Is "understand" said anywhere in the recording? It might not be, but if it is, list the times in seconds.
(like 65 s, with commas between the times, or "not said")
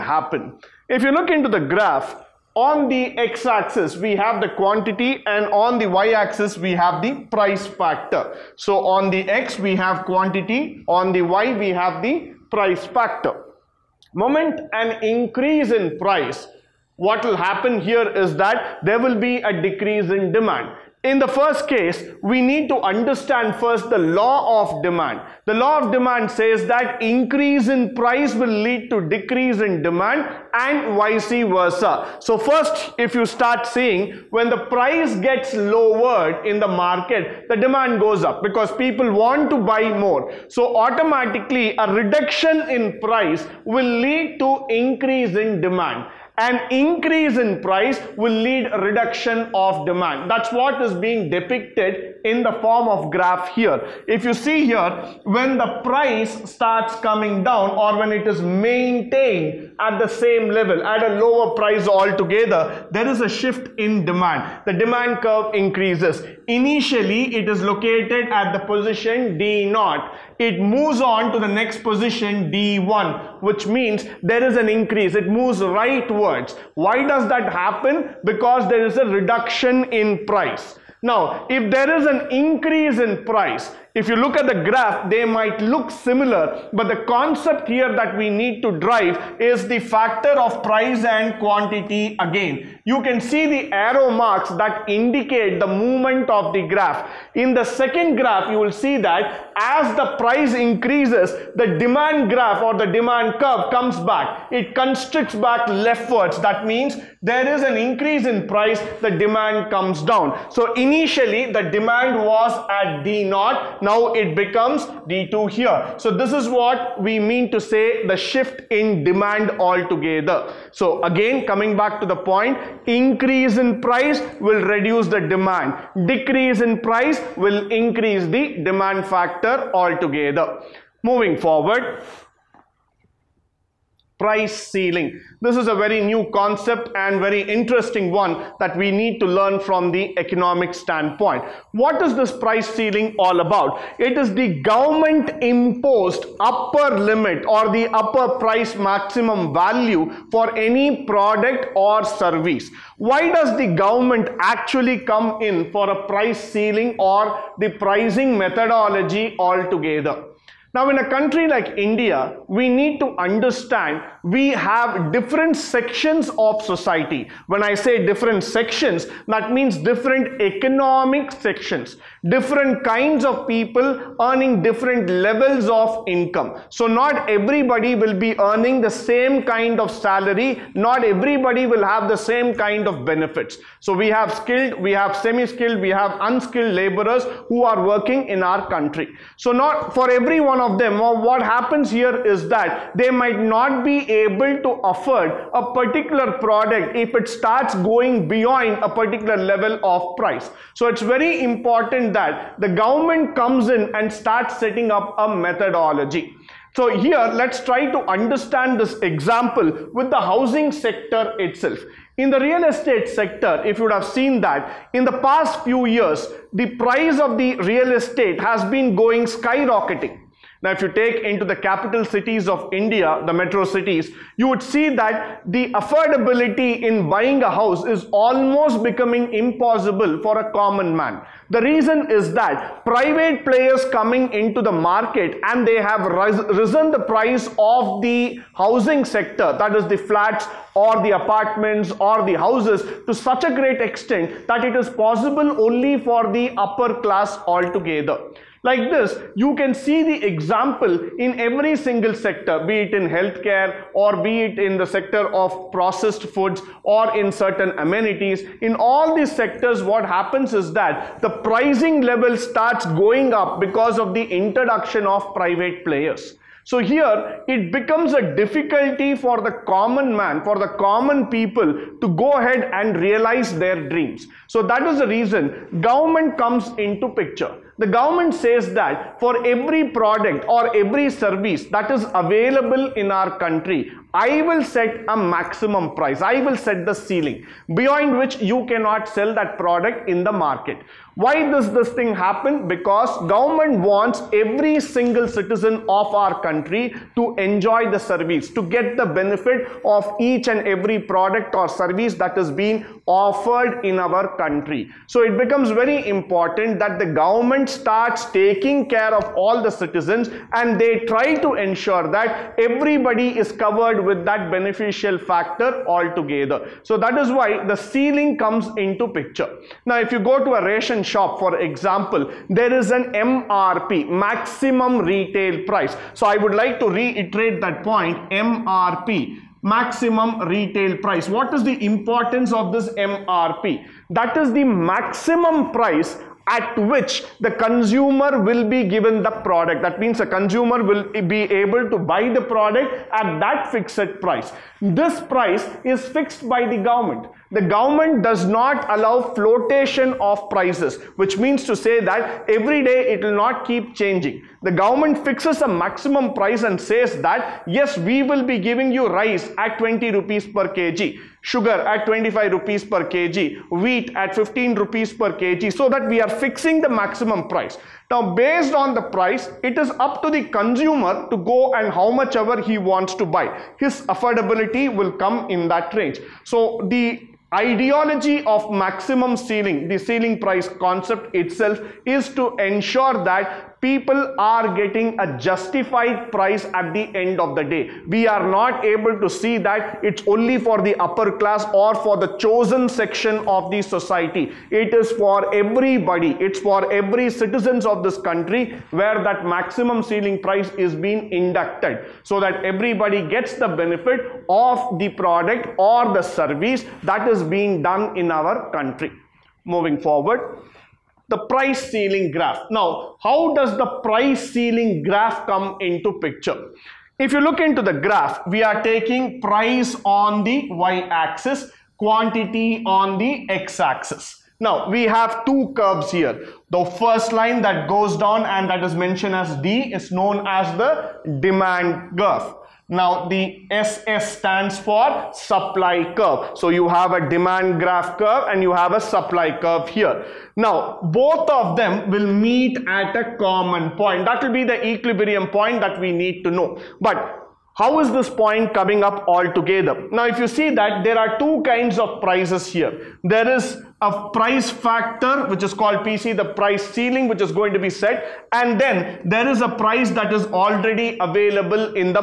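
22 s, 163 s, 207 s.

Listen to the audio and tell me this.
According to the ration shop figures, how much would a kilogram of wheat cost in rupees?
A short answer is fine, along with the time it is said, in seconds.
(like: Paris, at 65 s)
15 rupees, at 364 s.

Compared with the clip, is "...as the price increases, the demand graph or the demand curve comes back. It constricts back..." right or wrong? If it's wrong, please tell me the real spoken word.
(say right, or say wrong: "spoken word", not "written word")
right.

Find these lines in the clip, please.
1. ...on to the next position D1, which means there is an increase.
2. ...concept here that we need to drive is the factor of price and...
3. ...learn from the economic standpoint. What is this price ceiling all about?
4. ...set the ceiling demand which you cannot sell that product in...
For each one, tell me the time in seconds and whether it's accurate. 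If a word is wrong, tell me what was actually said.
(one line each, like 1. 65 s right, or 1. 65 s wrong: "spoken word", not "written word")
1. 70 s right
2. 87 s right
3. 139 s right
4. 286 s wrong: "beyond", not "demand".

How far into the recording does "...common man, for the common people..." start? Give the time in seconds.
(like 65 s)
269 s.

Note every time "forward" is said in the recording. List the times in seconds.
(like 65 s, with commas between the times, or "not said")
131 s, 409 s.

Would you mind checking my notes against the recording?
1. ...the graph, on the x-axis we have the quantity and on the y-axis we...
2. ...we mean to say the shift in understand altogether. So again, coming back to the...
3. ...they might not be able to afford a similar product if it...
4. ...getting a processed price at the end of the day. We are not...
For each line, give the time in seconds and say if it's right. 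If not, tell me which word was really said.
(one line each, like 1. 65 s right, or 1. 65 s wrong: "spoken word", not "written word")
1. 1 s right
2. 117 s wrong: "demand", not "understand"
3. 192 s wrong: "particular", not "similar"
4. 384 s wrong: "justified", not "processed".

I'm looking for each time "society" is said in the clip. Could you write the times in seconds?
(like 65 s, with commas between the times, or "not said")
166 s, 393 s.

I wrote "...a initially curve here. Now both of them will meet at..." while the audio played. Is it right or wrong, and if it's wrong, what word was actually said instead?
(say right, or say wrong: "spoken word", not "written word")
wrong: "supply", not "initially".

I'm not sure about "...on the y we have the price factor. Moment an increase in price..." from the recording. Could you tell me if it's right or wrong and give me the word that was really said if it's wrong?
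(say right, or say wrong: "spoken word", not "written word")
right.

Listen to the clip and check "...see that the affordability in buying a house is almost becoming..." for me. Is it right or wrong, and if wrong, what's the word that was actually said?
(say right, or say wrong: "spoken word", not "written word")
right.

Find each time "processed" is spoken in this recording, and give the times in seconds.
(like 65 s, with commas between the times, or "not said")
255 s.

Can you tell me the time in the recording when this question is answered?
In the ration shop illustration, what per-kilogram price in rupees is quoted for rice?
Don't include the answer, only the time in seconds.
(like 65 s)
359 s.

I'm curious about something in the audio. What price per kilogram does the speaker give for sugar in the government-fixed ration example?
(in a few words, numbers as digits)
25 rupees.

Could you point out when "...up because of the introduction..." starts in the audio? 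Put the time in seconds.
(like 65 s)
263 s.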